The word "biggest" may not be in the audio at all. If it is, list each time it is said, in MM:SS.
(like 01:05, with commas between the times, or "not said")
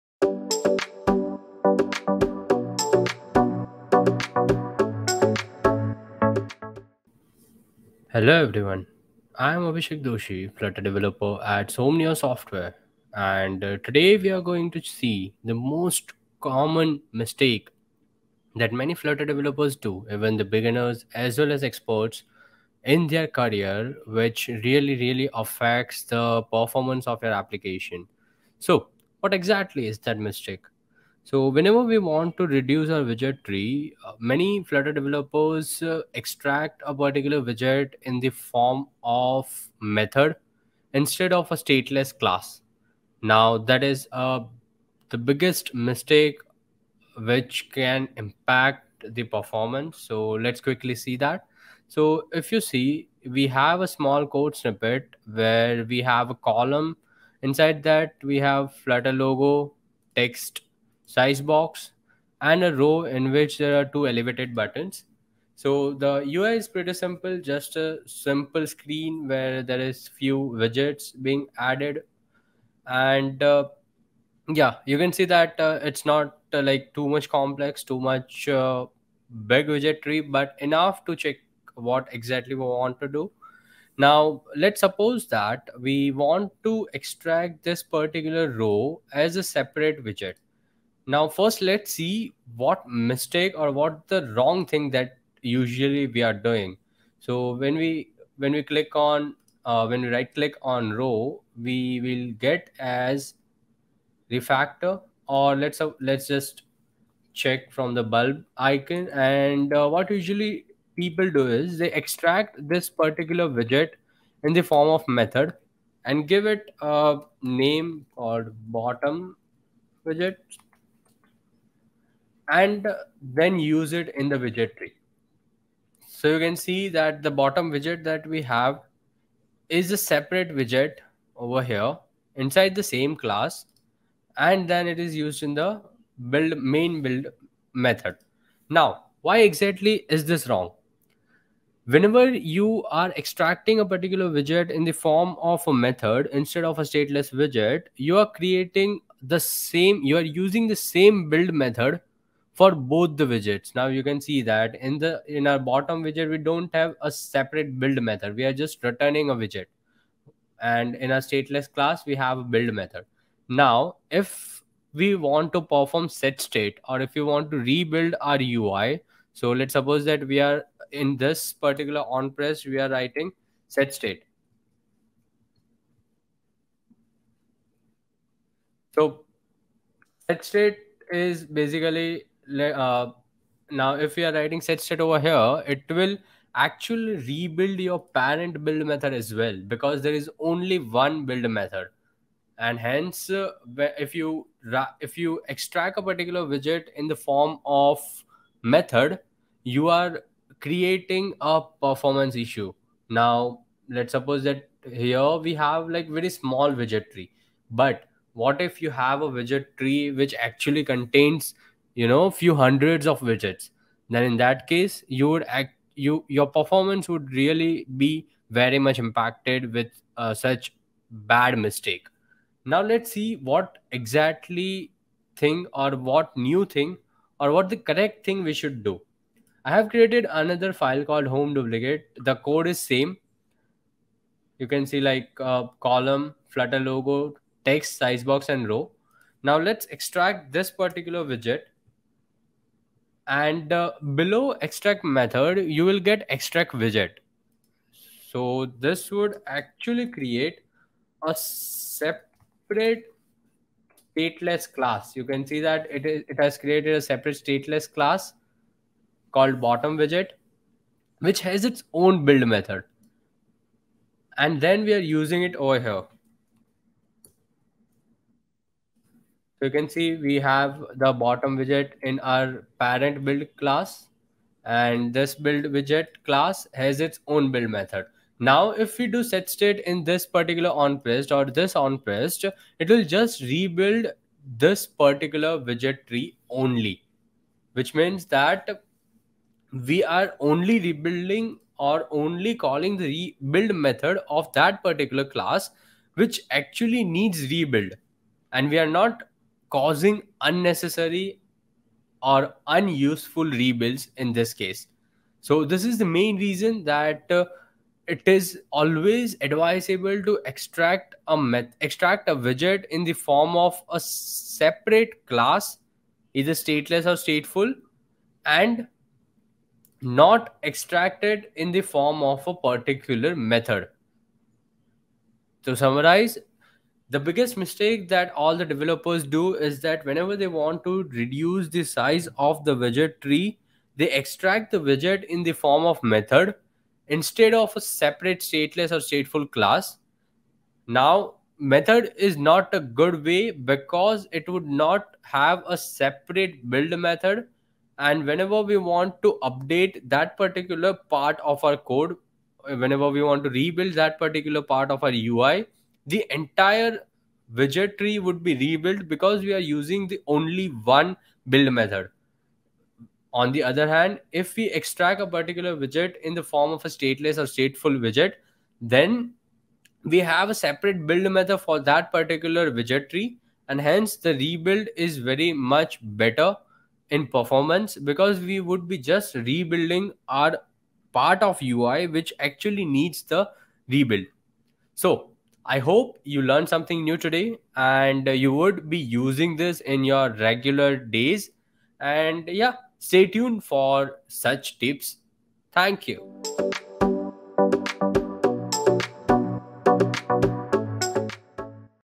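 00:45, 05:27.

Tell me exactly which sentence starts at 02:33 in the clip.
Now you can see that in the in our bottom widget, we don't have a separate build method.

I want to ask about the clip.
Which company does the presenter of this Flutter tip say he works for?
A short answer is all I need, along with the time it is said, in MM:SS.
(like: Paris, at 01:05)
Somnio Software, at 00:11.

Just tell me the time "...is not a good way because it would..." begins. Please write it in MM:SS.
05:42.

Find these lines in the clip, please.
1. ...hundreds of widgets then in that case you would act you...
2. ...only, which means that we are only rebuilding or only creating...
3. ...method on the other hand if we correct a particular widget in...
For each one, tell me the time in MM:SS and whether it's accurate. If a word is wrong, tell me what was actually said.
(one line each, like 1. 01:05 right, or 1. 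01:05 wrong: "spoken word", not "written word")
1. 03:32 right
2. 04:46 wrong: "calling", not "creating"
3. 06:01 wrong: "extract", not "correct".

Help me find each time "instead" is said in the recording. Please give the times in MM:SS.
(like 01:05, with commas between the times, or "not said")
00:40, 02:26, 05:37.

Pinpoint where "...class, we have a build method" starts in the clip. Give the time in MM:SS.
02:41.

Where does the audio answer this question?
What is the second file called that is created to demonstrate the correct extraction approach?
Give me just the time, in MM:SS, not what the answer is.
03:51.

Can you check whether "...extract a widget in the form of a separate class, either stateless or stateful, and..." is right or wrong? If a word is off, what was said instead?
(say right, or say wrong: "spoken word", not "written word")
right.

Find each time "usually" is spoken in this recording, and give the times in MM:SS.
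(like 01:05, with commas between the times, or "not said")
01:35, 01:50.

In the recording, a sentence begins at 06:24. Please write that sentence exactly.
So I hope you learned something new today and you would be using this in your regular days.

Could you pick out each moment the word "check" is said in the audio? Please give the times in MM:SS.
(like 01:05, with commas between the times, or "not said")
01:21, 01:47.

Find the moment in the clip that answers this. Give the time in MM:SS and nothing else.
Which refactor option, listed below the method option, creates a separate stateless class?
04:06.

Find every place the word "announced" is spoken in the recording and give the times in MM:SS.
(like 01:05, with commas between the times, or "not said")
not said.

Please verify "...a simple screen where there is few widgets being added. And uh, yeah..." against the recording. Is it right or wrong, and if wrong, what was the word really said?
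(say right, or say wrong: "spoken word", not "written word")
right.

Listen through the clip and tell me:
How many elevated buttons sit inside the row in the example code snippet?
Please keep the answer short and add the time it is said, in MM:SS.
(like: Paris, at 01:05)
2, at 01:03.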